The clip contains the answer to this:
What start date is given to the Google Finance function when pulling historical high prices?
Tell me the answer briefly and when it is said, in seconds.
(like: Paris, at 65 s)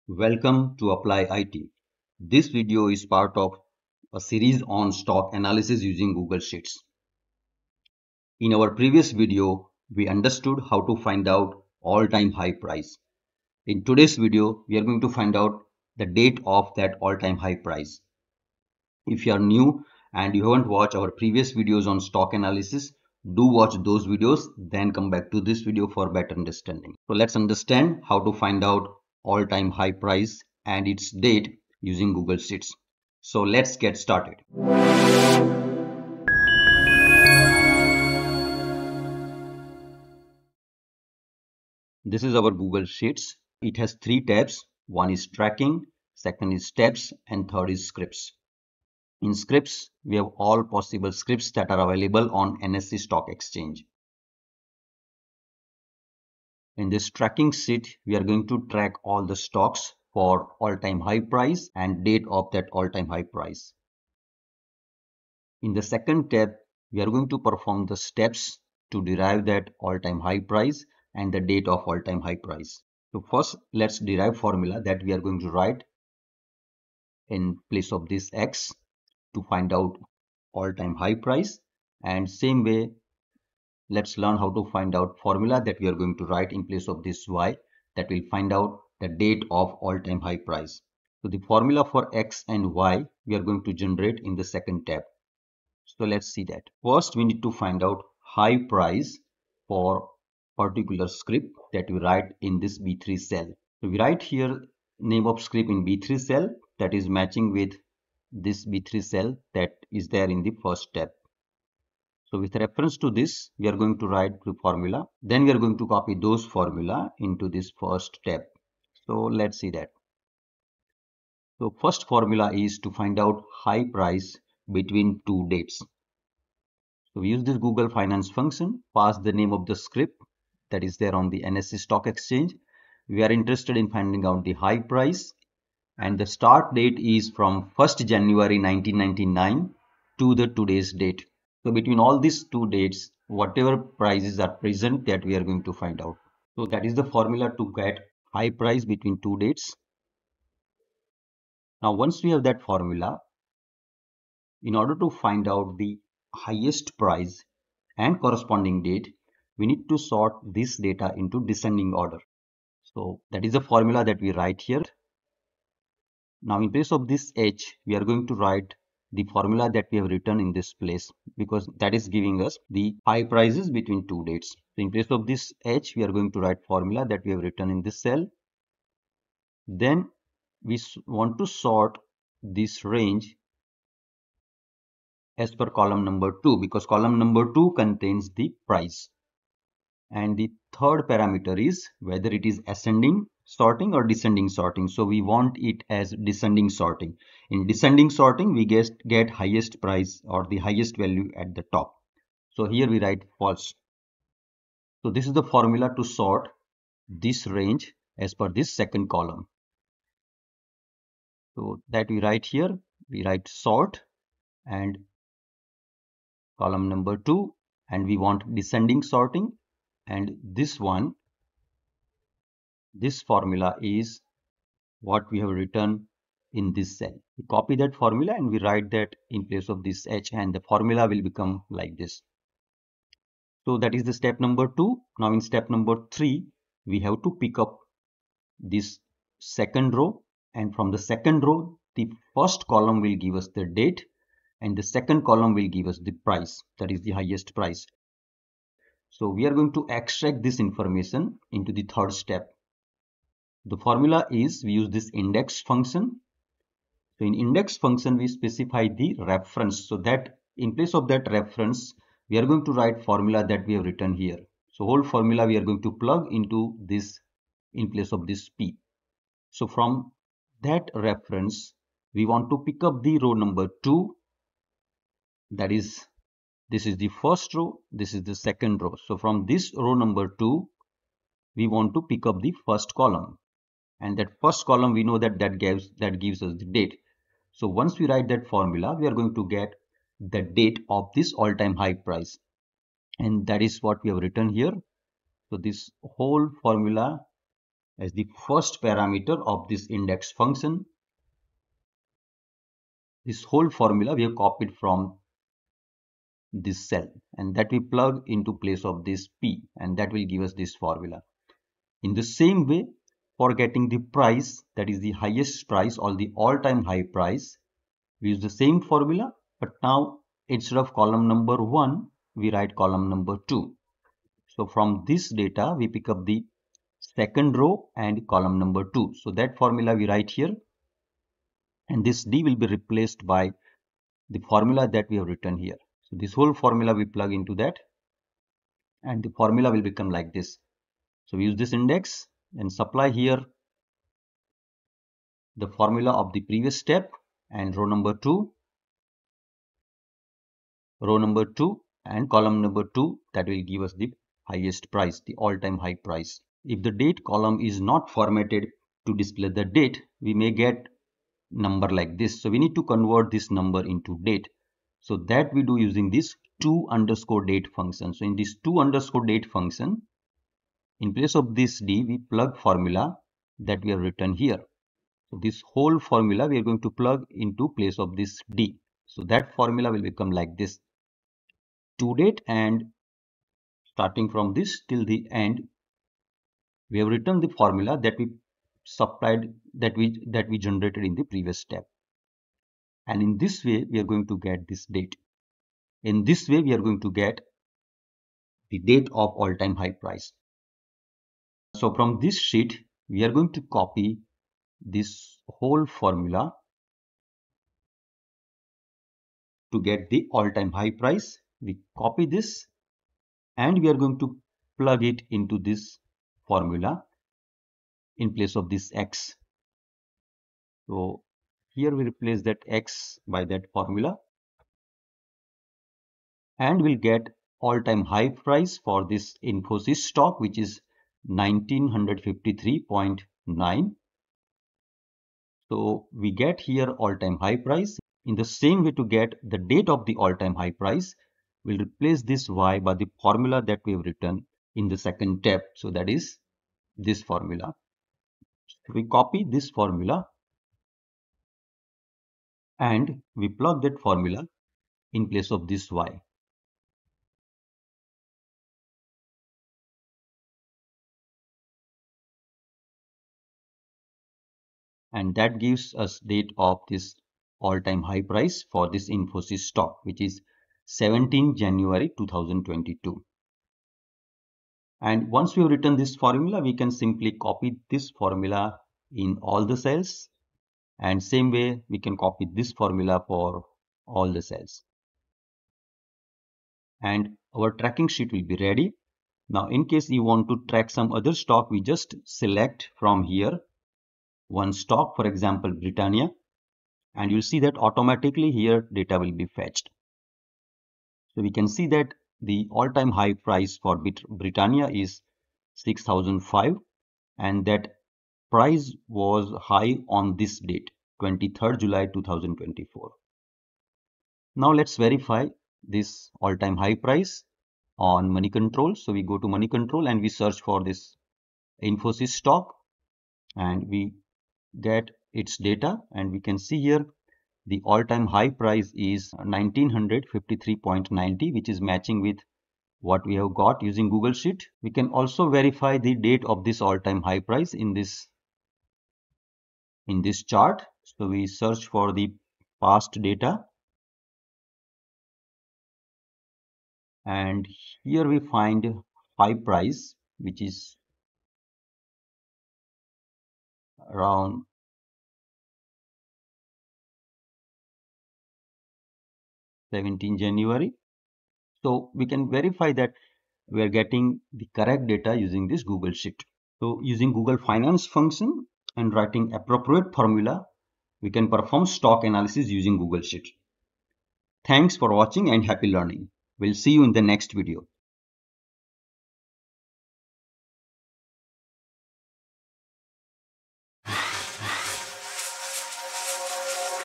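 1 January 1999, at 137 s.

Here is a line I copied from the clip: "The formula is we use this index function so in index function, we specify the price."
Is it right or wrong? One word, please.
wrong.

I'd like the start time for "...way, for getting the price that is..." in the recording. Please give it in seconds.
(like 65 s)
312 s.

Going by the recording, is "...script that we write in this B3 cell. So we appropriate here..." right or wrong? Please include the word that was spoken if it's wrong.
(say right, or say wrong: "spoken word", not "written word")
wrong: "write", not "appropriate".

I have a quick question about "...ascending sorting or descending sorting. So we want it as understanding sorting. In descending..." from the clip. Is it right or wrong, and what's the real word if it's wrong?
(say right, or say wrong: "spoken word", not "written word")
wrong: "descending", not "understanding".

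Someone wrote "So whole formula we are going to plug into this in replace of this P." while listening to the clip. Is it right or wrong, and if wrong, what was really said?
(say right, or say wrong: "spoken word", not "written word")
wrong: "place", not "replace".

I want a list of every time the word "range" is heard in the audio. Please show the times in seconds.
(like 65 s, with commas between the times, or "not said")
182 s, 207 s.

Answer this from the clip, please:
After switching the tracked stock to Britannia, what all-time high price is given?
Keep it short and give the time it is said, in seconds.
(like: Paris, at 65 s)
6005, at 505 s.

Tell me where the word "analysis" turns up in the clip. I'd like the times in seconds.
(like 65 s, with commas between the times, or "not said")
5 s, 22 s, 572 s.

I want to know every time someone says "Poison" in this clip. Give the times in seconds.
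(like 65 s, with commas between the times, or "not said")
not said.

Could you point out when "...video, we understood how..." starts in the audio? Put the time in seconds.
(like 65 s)
9 s.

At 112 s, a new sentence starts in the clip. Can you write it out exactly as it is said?
So with reference to this, we are going to write the formula.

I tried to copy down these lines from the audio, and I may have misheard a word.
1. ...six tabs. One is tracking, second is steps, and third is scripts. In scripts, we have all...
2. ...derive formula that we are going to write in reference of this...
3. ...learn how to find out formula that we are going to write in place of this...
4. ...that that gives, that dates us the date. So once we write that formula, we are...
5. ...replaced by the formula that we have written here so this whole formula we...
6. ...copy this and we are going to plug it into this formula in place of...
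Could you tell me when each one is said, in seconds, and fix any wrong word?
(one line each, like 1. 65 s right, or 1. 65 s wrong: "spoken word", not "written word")
1. 44 s wrong: "three", not "six"
2. 73 s wrong: "place", not "reference"
3. 84 s right
4. 285 s wrong: "gives", not "dates"
5. 332 s right
6. 411 s right.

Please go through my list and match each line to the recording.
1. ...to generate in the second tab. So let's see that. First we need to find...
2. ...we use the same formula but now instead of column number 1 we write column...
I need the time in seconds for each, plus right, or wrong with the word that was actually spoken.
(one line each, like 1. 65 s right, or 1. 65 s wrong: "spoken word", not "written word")
1. 93 s right
2. 318 s right.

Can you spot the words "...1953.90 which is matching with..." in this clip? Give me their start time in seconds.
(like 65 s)
529 s.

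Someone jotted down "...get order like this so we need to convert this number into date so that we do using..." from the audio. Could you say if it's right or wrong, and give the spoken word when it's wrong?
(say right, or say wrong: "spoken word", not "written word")
wrong: "number", not "order".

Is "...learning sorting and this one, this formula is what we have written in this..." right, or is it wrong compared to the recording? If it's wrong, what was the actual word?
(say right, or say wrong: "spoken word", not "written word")
wrong: "descending", not "learning".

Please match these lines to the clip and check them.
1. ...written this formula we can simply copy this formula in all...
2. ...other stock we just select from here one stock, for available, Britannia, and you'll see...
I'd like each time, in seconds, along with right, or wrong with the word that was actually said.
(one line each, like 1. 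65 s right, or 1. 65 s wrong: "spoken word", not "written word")
1. 475 s right
2. 491 s wrong: "example", not "available".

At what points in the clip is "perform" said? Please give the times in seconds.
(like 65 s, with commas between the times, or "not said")
67 s, 571 s.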